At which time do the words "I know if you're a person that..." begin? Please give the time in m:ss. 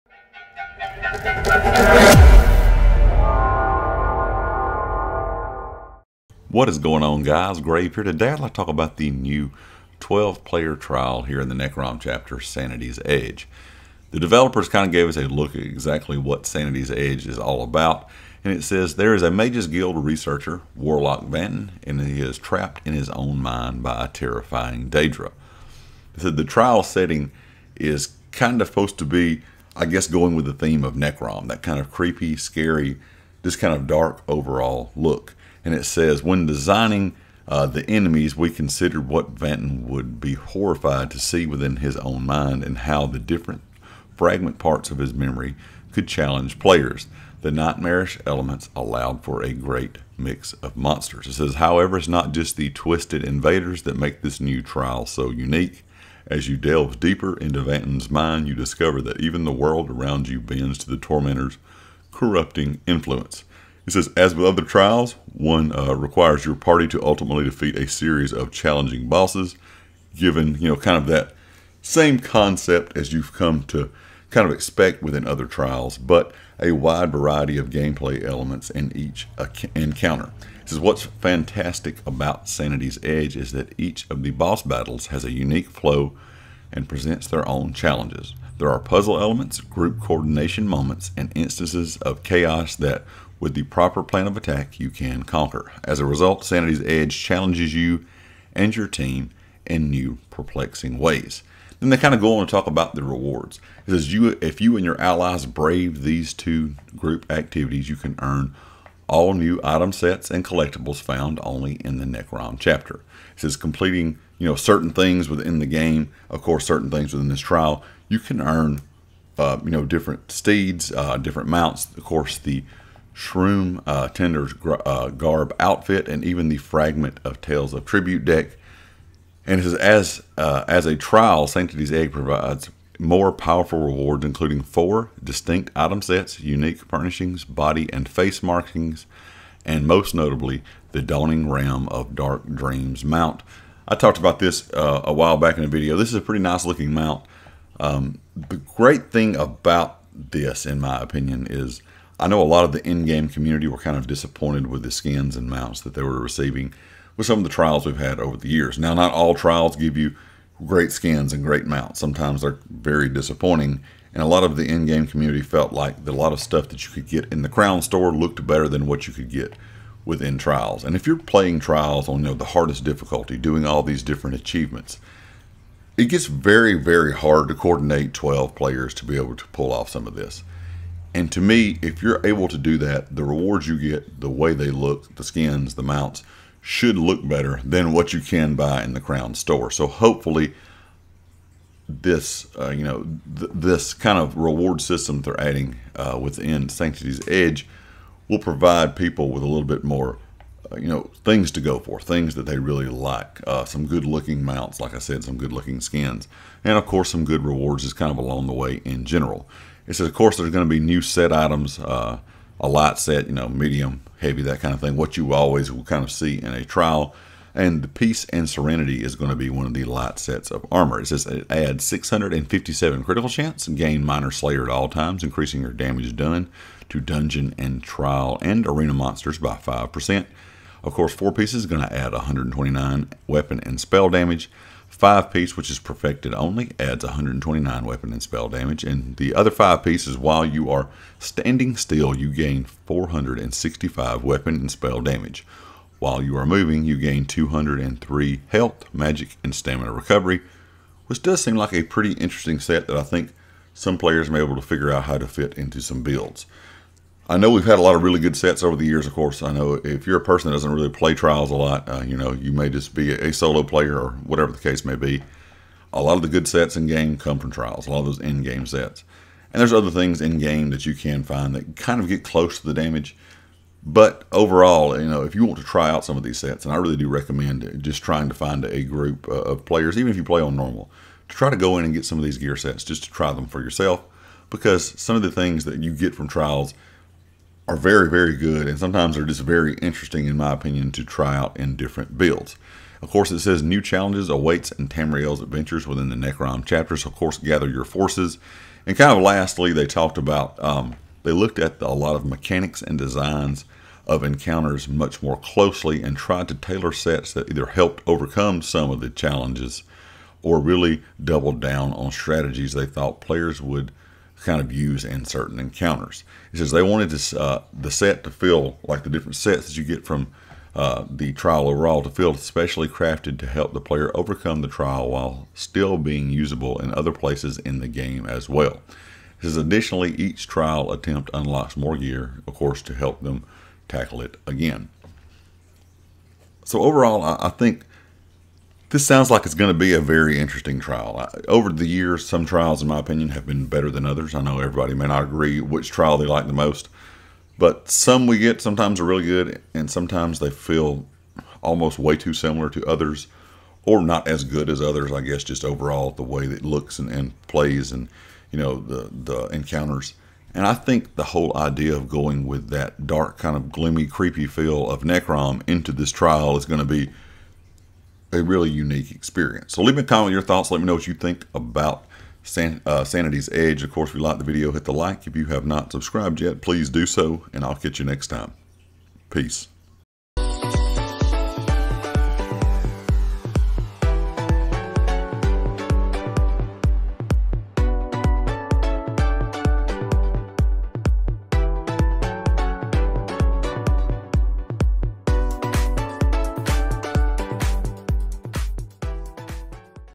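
4:19.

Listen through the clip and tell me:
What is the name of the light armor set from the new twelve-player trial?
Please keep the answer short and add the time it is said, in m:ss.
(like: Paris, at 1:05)
Peace and Serenity, at 3:37.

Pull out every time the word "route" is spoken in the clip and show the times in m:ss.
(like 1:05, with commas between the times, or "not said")
not said.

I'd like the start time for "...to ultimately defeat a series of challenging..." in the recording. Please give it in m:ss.
1:06.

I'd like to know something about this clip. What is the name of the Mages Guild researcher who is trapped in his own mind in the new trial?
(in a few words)
Warlock Vanton.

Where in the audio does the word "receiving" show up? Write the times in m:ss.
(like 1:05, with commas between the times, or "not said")
2:36.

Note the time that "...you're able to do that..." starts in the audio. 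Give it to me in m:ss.
3:02.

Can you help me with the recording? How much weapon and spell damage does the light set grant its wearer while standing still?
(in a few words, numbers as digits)
465.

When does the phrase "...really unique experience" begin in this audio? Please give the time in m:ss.
6:08.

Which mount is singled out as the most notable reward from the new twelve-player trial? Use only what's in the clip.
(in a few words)
Dawning Ram of Dark Dreams.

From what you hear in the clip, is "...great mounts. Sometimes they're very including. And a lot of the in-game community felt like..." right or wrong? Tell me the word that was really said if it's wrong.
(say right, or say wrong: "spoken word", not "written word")
wrong: "disappointing", not "including".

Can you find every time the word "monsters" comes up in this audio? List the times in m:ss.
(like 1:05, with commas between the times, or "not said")
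0:50, 3:48.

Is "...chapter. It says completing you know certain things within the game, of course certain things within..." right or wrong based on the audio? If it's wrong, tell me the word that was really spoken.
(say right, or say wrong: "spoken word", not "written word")
right.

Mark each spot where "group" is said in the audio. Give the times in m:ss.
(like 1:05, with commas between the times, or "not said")
1:29, 1:46, 4:38.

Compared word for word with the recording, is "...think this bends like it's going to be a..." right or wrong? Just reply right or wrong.
wrong.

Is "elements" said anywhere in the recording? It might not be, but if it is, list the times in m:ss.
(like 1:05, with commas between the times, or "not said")
0:48, 1:18, 1:29.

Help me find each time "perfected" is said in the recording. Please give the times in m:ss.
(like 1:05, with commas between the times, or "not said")
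3:55.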